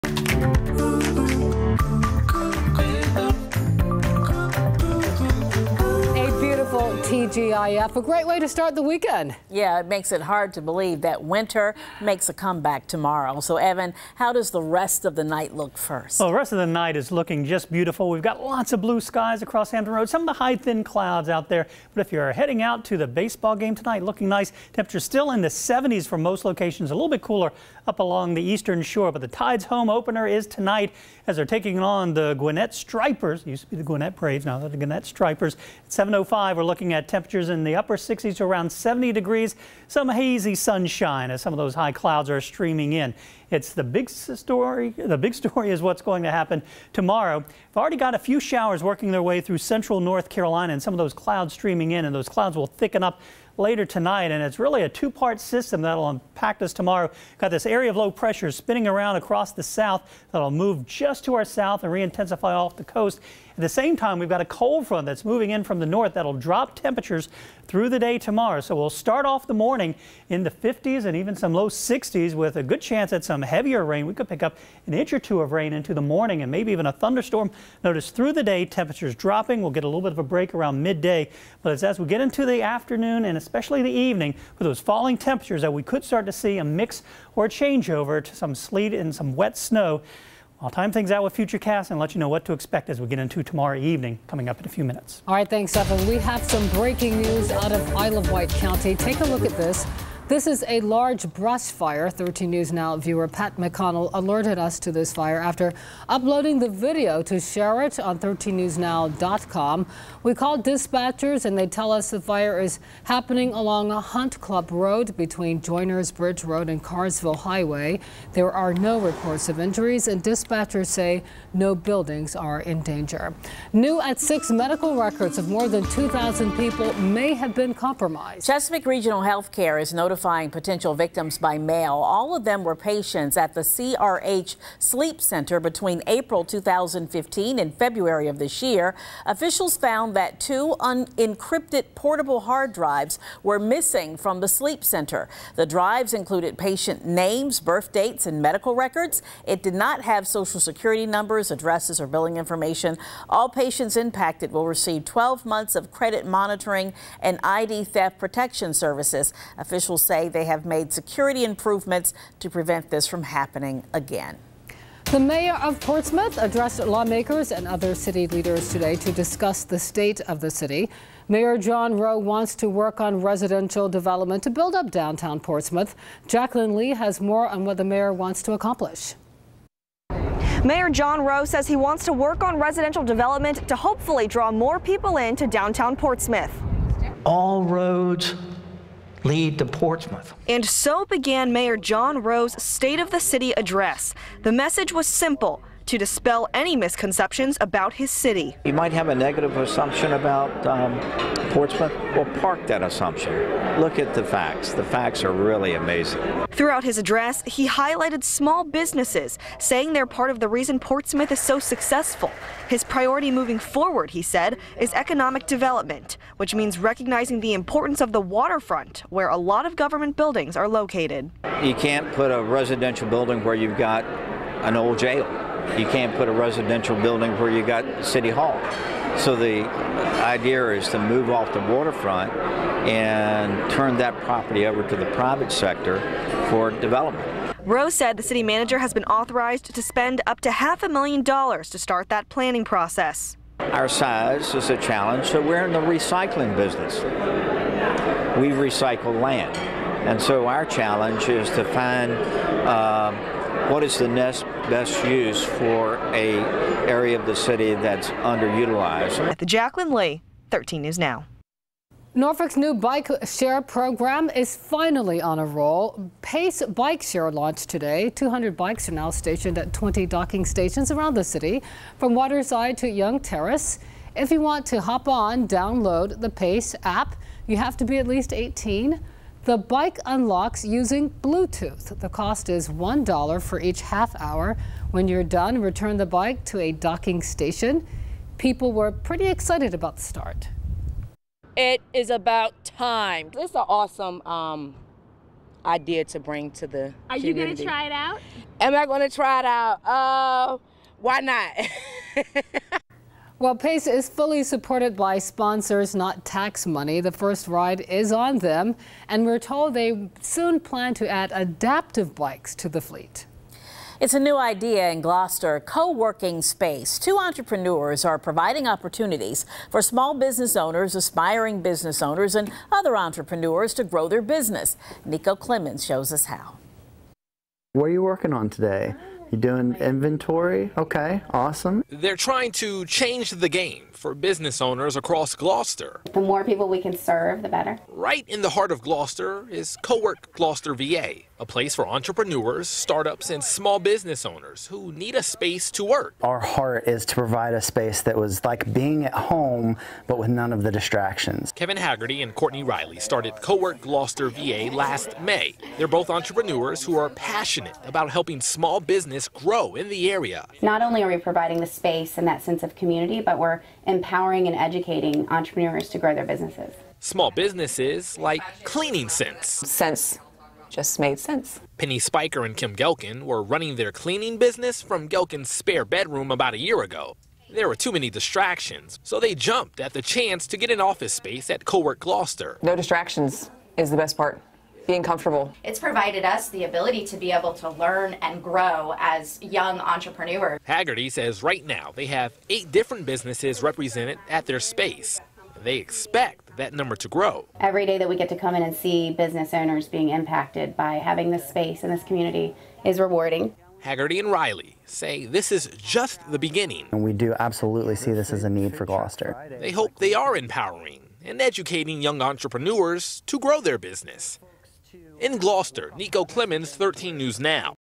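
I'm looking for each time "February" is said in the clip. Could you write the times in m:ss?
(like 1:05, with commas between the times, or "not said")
2:17.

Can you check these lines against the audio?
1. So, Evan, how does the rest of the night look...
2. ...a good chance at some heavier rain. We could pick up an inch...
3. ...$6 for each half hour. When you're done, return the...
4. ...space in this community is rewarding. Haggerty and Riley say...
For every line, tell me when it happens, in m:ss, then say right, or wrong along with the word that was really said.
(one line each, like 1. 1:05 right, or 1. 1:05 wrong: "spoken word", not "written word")
1. 0:13 right
2. 1:12 right
3. 4:42 wrong: "1", not "6"
4. 6:41 right.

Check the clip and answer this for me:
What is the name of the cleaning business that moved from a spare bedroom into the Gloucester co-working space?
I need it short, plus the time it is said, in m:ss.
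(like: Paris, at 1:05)
Cleaning Sense, at 6:08.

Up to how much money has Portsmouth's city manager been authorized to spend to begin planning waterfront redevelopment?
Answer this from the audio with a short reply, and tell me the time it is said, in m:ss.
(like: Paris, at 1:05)
half a million dollars, at 4:00.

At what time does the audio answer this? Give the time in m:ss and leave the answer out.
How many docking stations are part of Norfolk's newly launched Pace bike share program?
4:29.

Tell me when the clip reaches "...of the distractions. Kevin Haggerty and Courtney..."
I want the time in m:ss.
5:50.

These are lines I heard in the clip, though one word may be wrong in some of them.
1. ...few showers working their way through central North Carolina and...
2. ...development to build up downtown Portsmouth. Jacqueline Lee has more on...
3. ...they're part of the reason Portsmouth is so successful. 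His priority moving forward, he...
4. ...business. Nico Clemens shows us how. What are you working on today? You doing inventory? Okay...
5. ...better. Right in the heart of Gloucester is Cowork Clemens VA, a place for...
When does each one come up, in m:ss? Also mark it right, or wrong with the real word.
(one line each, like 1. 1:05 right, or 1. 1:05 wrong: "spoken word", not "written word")
1. 0:48 right
2. 2:53 right
3. 3:29 right
4. 5:24 right
5. 5:37 wrong: "Gloucester", not "Clemens".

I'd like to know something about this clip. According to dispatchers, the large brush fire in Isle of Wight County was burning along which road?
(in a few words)
Hunt Club Road.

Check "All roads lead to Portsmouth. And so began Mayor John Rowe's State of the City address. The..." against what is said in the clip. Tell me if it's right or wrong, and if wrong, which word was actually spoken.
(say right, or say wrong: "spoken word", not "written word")
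right.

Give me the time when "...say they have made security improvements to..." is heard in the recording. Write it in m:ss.
2:40.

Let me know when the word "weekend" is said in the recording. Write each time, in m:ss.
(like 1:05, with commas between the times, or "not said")
0:08.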